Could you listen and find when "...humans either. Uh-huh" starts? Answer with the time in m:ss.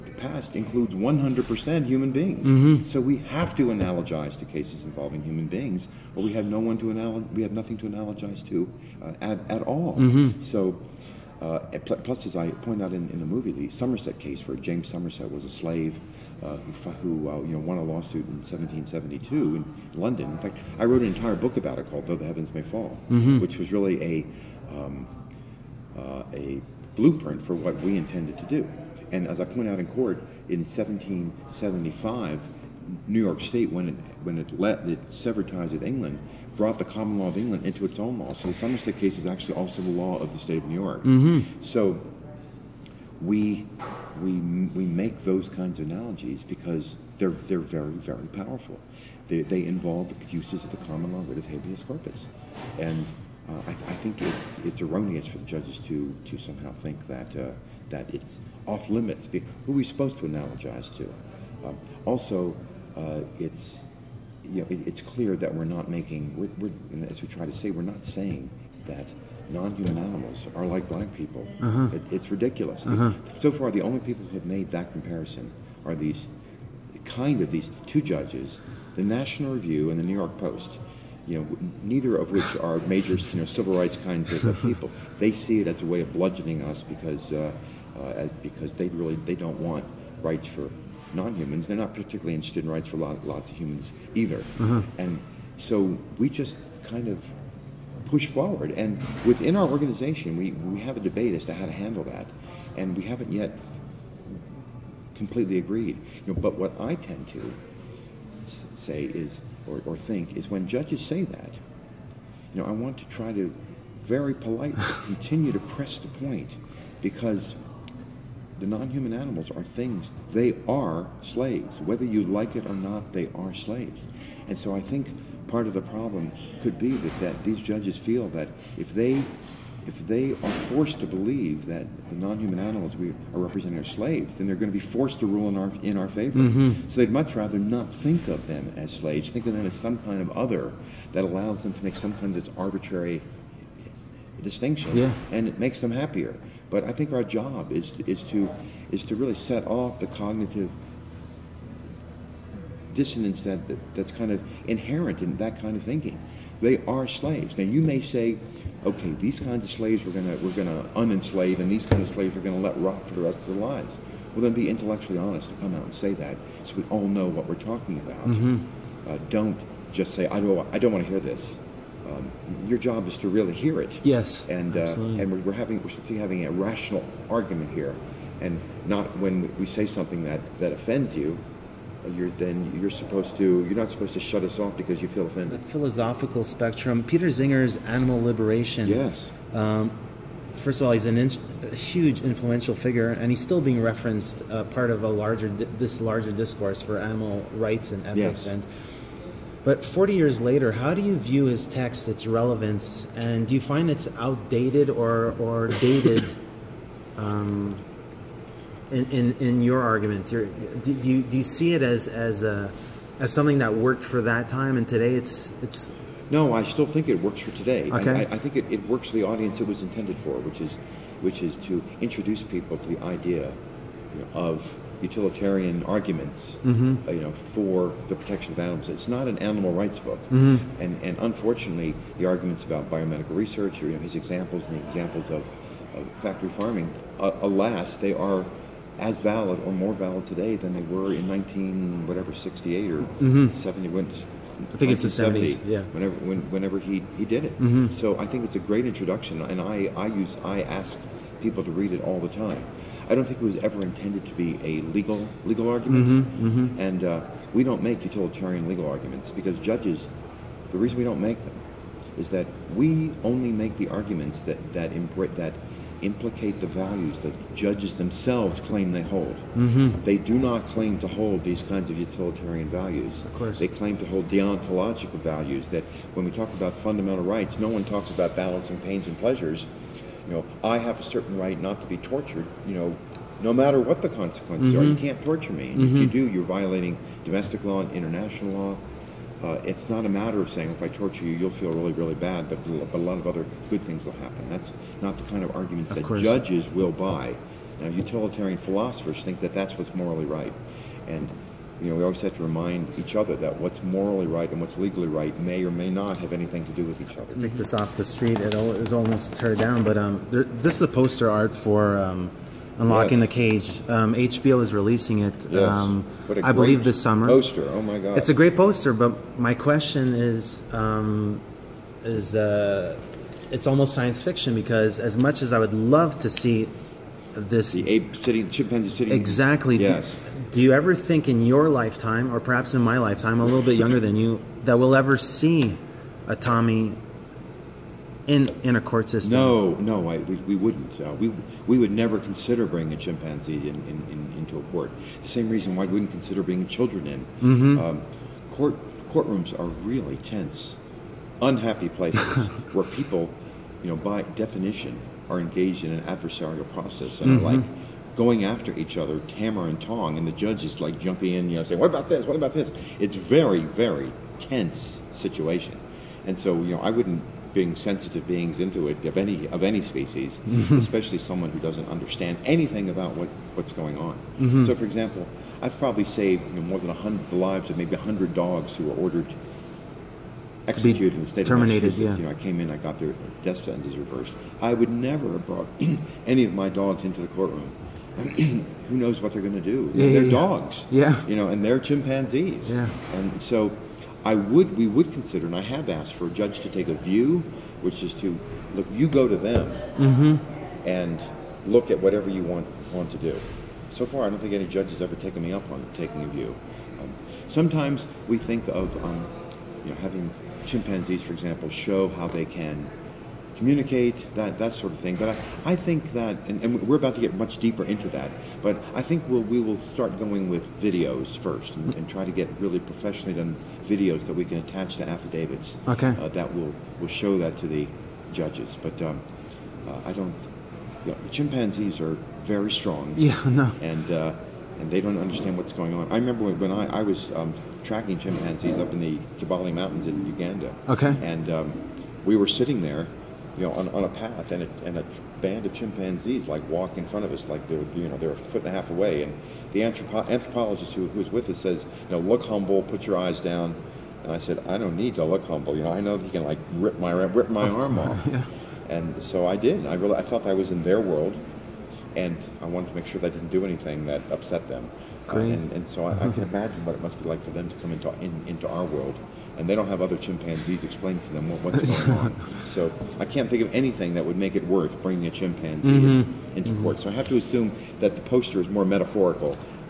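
1:33.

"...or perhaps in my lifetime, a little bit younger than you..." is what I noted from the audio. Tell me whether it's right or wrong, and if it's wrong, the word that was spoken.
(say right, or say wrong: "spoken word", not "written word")
right.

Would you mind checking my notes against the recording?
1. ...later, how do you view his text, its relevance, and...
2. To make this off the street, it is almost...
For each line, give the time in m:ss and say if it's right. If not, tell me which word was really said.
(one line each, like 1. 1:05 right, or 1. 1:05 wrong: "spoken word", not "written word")
1. 3:20 right
2. 5:07 right.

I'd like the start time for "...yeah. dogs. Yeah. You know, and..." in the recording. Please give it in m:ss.
6:30.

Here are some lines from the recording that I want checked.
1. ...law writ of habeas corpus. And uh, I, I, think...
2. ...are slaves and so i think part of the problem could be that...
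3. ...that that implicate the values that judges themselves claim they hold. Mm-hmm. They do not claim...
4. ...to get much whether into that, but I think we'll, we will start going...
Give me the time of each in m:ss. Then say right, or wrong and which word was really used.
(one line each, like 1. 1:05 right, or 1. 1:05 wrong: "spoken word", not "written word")
1. 0:51 right
2. 2:03 right
3. 4:24 right
4. 6:57 wrong: "deeper", not "whether".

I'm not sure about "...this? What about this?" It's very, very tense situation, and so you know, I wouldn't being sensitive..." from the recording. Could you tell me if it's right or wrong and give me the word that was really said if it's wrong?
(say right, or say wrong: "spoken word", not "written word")
right.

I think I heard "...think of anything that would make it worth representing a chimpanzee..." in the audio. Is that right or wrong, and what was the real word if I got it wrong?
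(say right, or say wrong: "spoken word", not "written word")
wrong: "bringing", not "representing".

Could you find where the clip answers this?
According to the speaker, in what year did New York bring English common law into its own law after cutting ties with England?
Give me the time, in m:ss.
0:30.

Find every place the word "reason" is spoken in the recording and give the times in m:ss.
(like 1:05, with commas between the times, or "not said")
4:20, 5:45.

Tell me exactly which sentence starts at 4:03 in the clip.
70 when I think it's the 70s yeah whenever when, whenever he he did it mm-hmm.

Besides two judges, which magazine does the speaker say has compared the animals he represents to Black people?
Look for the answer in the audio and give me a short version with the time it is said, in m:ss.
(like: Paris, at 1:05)
National Review, at 1:18.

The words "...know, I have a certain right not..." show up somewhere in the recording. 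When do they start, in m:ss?
4:40.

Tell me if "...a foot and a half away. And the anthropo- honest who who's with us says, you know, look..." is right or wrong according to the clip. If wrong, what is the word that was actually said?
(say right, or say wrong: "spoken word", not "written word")
wrong: "anthropologist", not "honest".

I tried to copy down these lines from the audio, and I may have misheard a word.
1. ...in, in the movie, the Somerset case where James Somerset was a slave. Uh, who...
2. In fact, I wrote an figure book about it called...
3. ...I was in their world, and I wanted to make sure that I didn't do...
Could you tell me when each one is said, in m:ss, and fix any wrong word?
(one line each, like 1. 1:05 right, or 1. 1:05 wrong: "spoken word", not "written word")
1. 0:12 right
2. 0:20 wrong: "entire", not "figure"
3. 7:40 right.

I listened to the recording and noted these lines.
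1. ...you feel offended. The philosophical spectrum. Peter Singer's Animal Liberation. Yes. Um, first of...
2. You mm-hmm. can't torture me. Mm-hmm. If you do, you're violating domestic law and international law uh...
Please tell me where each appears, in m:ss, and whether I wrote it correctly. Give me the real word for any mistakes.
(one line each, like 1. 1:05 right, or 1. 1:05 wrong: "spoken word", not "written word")
1. 3:05 right
2. 4:44 right.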